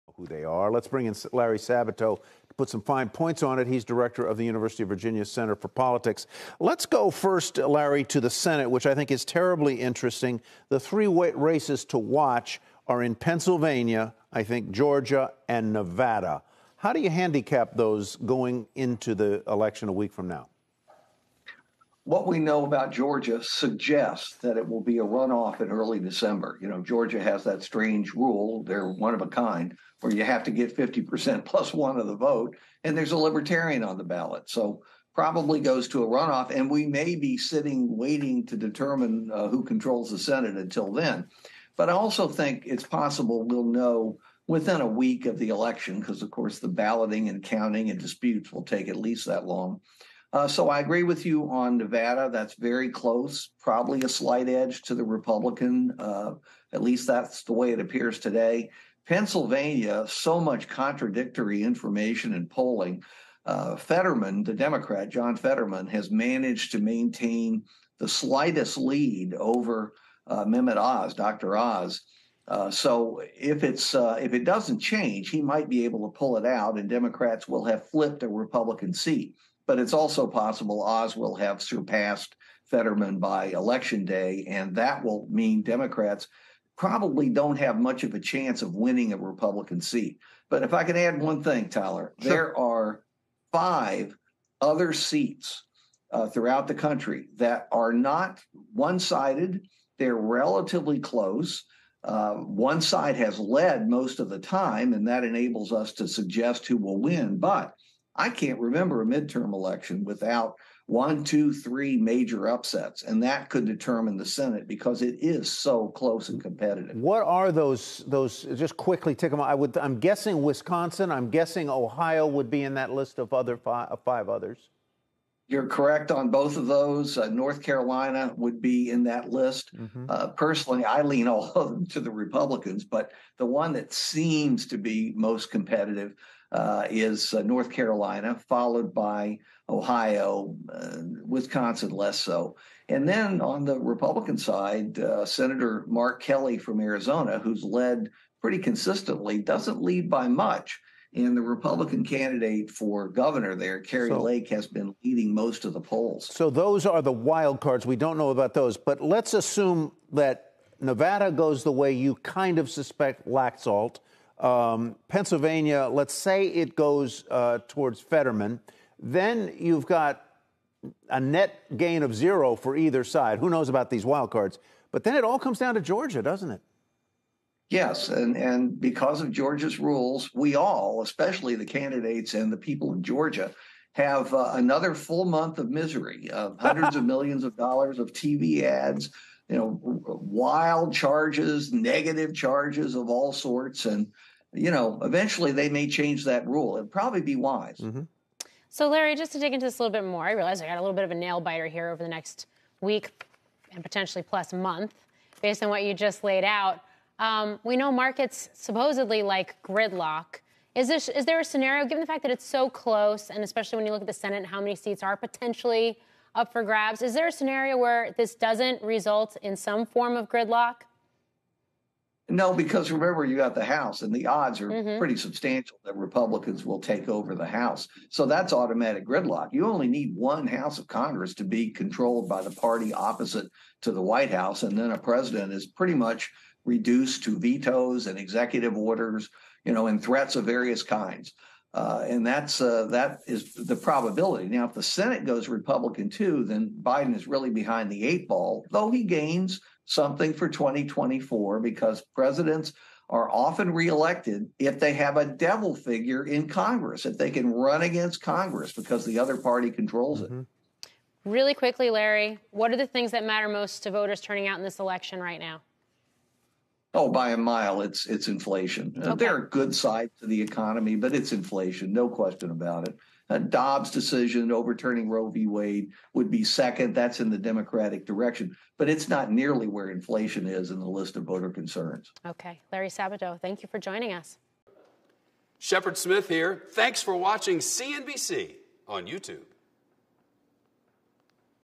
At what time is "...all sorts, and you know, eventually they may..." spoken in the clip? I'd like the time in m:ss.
3:13.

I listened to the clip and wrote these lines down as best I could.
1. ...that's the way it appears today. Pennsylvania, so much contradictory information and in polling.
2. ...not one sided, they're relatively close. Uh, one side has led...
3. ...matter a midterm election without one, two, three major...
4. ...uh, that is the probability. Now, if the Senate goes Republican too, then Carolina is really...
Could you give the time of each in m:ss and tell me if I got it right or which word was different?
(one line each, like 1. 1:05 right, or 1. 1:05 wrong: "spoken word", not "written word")
1. 0:57 right
2. 1:37 right
3. 1:48 wrong: "remember", not "matter"
4. 4:02 wrong: "Biden", not "Carolina".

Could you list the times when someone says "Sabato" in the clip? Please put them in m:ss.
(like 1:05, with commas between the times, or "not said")
0:01, 4:42.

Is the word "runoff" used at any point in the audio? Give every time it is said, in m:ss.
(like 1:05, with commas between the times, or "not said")
0:25, 0:36.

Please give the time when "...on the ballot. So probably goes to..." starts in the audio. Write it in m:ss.
0:33.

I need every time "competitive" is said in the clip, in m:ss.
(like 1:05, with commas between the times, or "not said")
1:56, 2:15.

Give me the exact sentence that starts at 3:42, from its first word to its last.
No, because remember, you got the House, and the odds are mm-hmm.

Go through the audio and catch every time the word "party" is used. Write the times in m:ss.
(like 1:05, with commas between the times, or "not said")
3:52, 4:19.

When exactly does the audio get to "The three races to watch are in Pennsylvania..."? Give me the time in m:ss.
0:10.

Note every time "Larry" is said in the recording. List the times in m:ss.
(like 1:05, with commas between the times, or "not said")
0:01, 0:07, 3:18, 4:21, 4:42.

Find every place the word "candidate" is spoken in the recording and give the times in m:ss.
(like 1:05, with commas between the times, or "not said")
2:32, 3:01.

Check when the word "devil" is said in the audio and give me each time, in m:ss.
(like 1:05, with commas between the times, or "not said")
4:15.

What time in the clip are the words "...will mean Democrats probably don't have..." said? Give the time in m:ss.
1:25.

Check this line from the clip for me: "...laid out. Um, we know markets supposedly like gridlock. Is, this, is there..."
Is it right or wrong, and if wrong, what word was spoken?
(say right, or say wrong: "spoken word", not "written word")
right.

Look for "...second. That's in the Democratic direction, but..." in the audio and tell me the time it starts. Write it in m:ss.
4:36.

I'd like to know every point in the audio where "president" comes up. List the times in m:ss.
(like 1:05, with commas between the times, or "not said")
3:54, 4:12.